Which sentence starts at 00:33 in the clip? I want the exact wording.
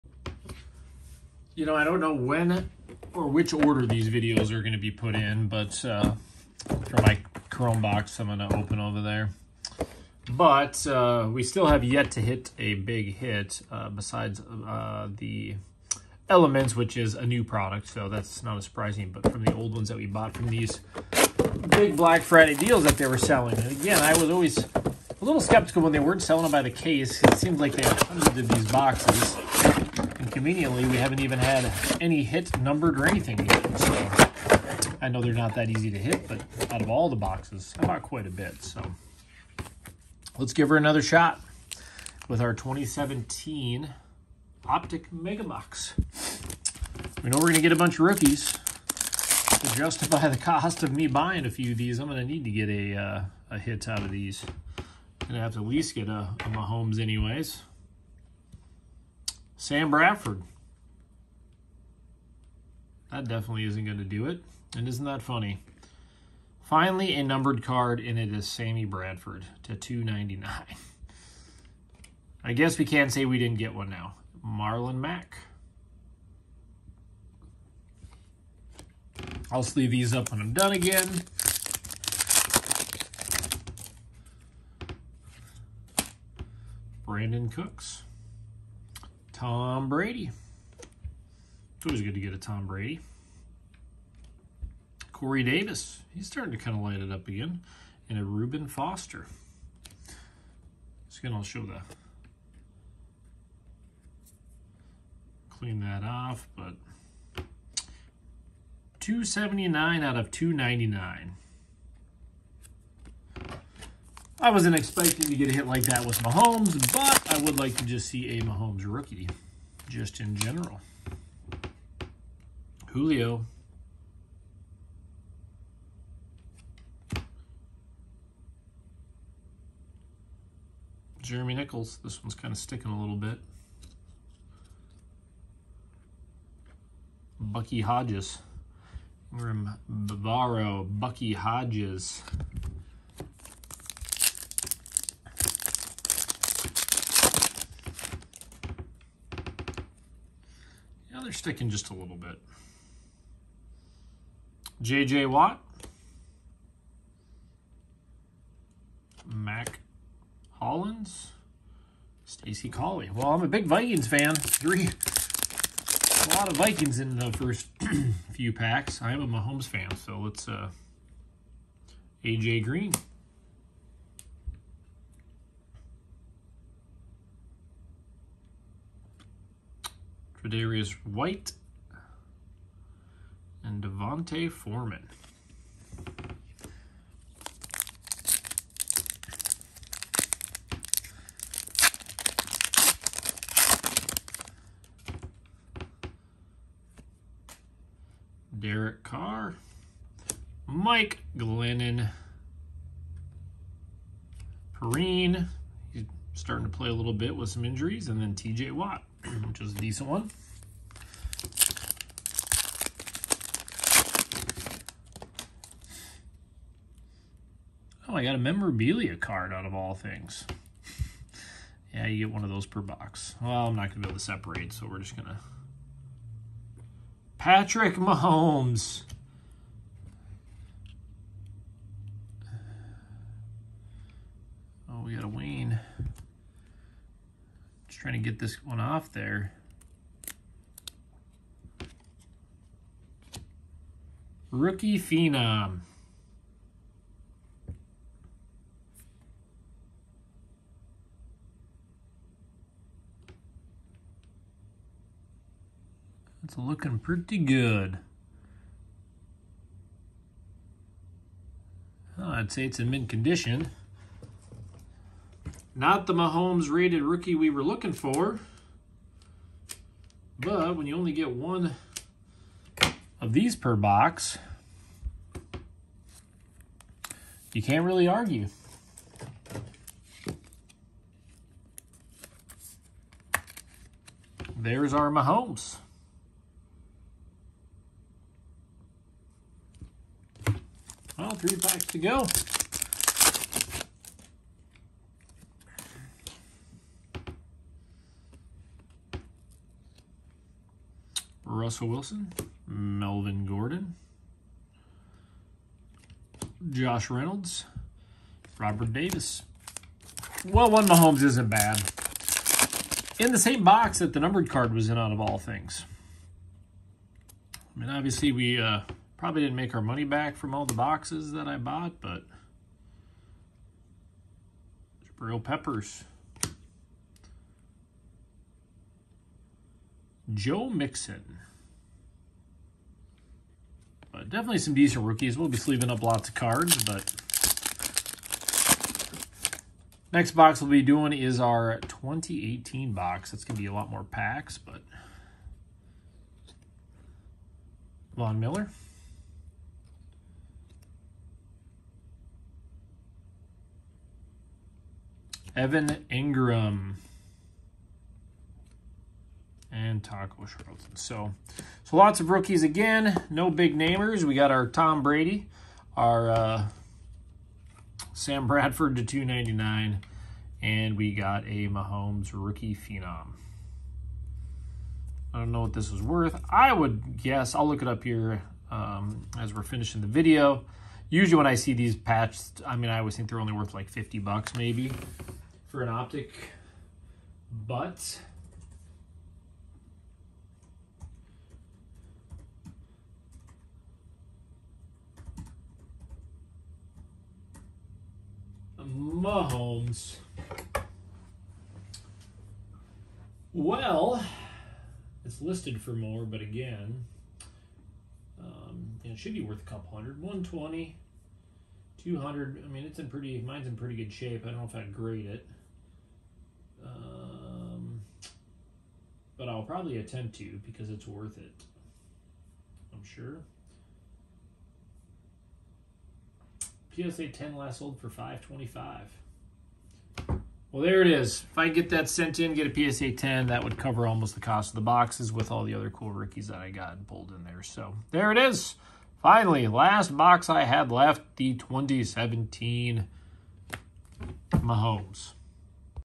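So I know they're not that easy to hit, but out of all the boxes, I bought quite a bit.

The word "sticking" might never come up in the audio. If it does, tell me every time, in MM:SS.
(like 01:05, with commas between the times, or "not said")
02:12, 02:31.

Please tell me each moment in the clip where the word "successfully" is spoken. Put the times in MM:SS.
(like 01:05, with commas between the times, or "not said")
not said.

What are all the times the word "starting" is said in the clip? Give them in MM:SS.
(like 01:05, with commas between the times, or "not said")
01:36, 03:26.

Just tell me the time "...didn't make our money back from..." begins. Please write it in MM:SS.
05:19.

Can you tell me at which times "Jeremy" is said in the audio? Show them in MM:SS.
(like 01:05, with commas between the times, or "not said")
02:11.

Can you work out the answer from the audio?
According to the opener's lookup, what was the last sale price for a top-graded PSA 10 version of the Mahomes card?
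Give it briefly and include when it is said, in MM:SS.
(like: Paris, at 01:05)
525, at 07:08.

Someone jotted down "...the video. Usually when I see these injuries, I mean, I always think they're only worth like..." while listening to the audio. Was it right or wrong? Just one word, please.
wrong.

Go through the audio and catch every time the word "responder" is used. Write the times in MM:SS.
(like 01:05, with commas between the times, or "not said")
not said.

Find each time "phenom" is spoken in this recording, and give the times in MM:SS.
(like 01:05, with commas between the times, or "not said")
04:04, 06:12.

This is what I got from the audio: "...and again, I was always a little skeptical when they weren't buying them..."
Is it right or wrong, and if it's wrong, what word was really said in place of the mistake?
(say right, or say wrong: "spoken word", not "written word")
wrong: "selling", not "buying".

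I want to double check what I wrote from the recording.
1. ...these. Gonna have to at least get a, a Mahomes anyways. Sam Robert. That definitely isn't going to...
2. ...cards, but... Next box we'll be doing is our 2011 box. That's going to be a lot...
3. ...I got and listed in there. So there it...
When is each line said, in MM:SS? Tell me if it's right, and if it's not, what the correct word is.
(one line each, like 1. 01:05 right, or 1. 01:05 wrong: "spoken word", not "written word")
1. 00:54 wrong: "Bradford", not "Robert"
2. 05:36 wrong: "2018", not "2011"
3. 07:16 wrong: "pulled", not "listed".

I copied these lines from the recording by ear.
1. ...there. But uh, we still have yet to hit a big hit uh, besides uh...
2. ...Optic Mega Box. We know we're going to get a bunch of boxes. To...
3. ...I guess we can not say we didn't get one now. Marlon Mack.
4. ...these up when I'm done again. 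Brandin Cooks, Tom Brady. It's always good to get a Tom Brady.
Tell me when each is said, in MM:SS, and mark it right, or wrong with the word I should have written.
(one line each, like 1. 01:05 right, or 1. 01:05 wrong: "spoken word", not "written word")
1. 00:09 right
2. 00:44 wrong: "rookies", not "boxes"
3. 01:12 right
4. 01:19 right.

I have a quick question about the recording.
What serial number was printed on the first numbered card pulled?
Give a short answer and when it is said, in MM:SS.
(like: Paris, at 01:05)
279, at 01:49.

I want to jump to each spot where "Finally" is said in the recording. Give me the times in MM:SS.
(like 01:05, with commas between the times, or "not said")
01:06, 07:19.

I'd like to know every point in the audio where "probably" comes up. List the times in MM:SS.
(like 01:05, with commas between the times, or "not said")
05:19, 06:59.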